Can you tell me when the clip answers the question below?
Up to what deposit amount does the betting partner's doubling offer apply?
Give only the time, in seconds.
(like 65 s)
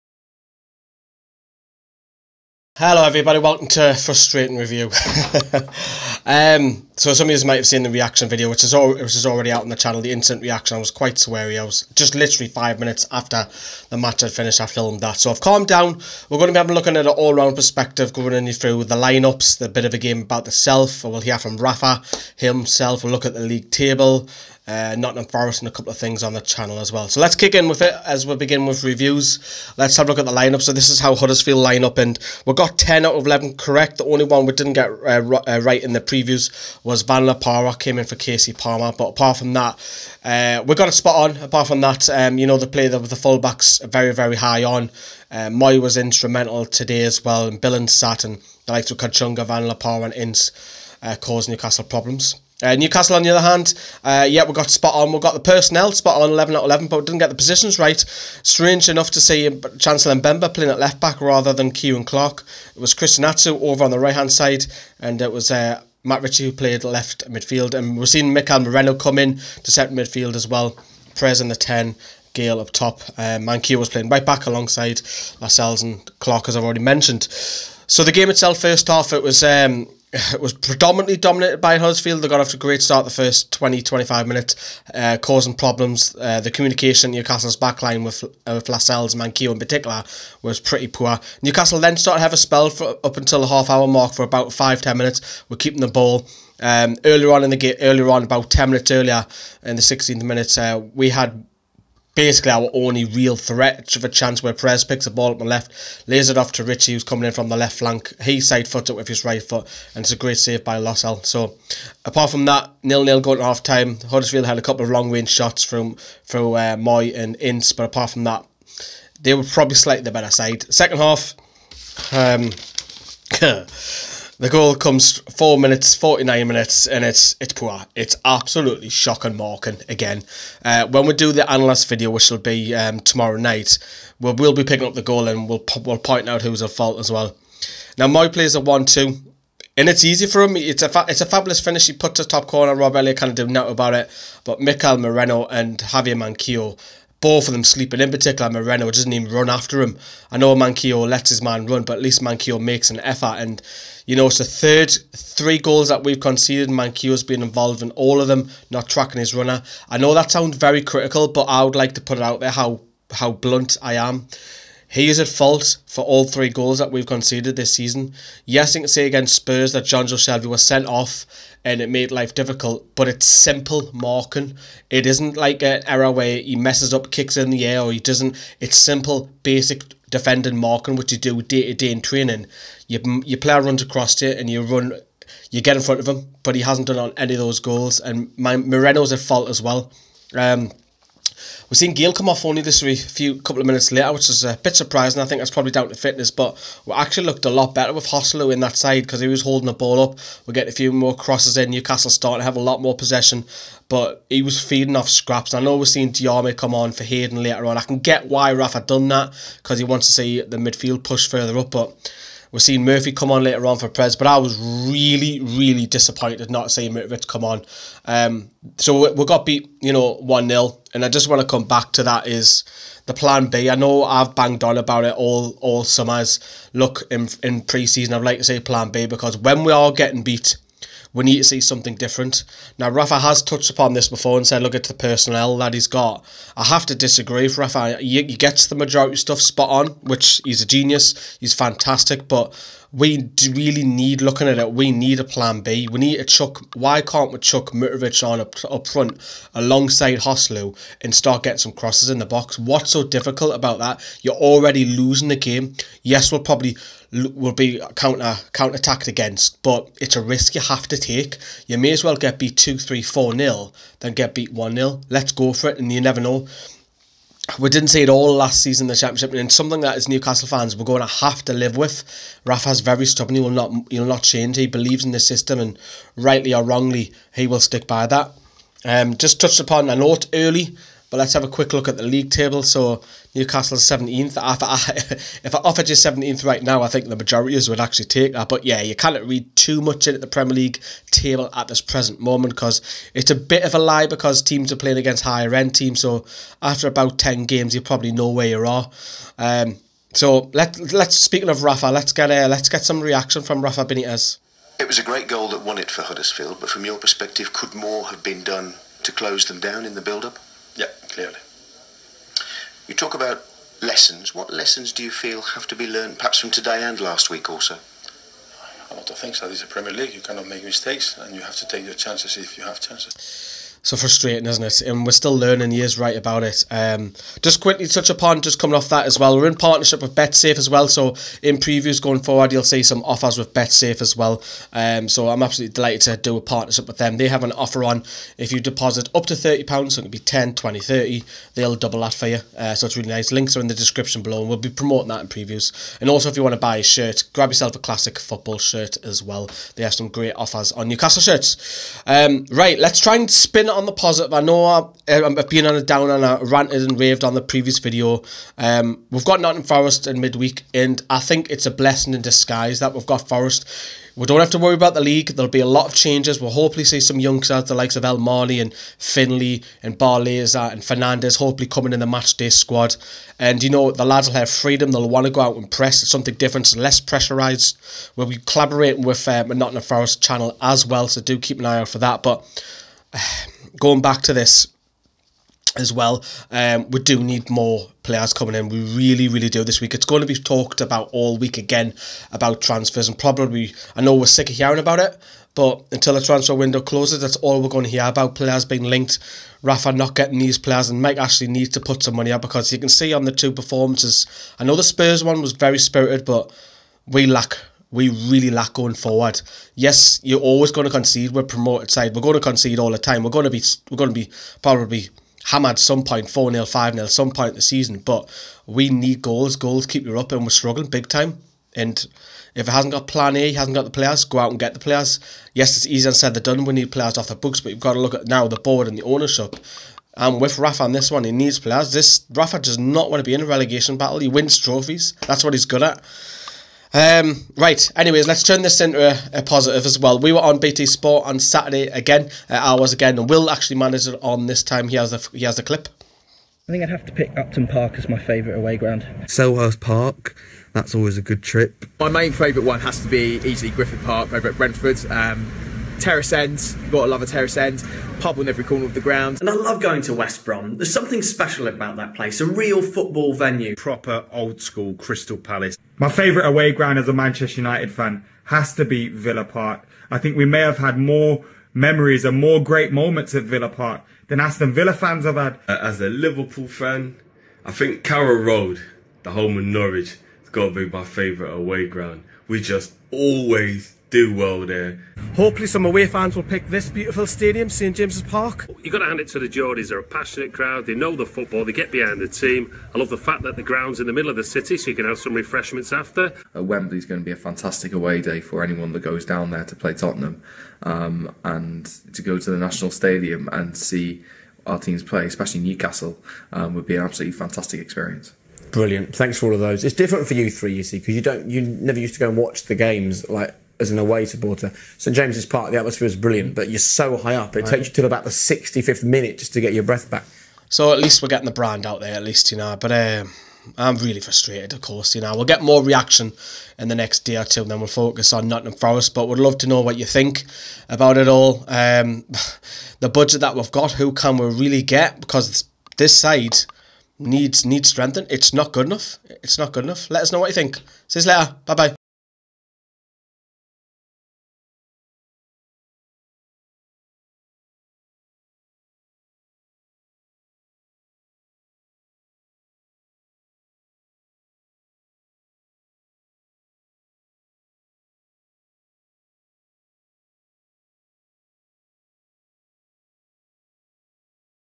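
339 s.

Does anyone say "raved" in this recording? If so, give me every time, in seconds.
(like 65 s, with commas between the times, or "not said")
356 s.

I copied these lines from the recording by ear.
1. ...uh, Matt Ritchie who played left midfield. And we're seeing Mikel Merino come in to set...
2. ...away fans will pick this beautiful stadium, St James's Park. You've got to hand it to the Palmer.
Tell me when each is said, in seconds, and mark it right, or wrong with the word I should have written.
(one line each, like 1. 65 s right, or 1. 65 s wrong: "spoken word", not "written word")
1. 65 s right
2. 485 s wrong: "Geordies", not "Palmer".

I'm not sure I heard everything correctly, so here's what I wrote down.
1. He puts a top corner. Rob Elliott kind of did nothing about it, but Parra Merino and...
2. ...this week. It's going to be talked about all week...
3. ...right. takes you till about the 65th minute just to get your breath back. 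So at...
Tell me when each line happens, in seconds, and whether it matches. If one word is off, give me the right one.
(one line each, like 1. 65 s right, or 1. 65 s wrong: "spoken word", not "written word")
1. 141 s wrong: "Mikel", not "Parra"
2. 389 s right
3. 517 s right.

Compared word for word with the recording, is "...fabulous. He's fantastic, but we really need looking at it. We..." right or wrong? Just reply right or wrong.
wrong.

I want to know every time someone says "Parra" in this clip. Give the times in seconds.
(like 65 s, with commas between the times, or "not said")
37 s, 49 s.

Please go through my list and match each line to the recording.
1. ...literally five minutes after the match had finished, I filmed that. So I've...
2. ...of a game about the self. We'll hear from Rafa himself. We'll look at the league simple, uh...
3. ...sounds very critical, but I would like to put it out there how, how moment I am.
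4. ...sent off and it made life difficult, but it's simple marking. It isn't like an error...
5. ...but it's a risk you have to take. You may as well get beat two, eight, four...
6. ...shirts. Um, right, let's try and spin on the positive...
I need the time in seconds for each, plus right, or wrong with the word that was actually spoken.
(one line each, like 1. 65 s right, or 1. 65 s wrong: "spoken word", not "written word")
1. 12 s right
2. 19 s wrong: "table", not "simple"
3. 160 s wrong: "blunt", not "moment"
4. 170 s right
5. 259 s wrong: "three", not "eight"
6. 351 s right.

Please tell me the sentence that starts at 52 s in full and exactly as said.
Uh, Newcastle, on the other hand, uh, yeah, we got spot on.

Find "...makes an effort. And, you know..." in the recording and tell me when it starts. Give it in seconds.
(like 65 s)
152 s.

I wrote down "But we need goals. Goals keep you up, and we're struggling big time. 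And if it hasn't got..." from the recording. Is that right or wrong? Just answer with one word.
right.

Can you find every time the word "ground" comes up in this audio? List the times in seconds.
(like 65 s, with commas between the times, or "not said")
448 s, 459 s, 466 s, 481 s, 493 s.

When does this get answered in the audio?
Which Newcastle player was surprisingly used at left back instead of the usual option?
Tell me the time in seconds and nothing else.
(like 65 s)
59 s.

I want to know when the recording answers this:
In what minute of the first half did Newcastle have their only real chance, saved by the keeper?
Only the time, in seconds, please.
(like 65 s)
99 s.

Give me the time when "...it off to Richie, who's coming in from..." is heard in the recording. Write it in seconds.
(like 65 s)
106 s.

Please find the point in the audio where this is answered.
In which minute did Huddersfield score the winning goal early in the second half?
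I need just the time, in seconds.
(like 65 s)
125 s.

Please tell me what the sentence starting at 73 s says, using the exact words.
Um, uh, Manquillo was playing right back alongside Lascelles and Clark, as I've already mentioned.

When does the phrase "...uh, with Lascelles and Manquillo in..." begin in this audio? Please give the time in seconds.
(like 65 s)
88 s.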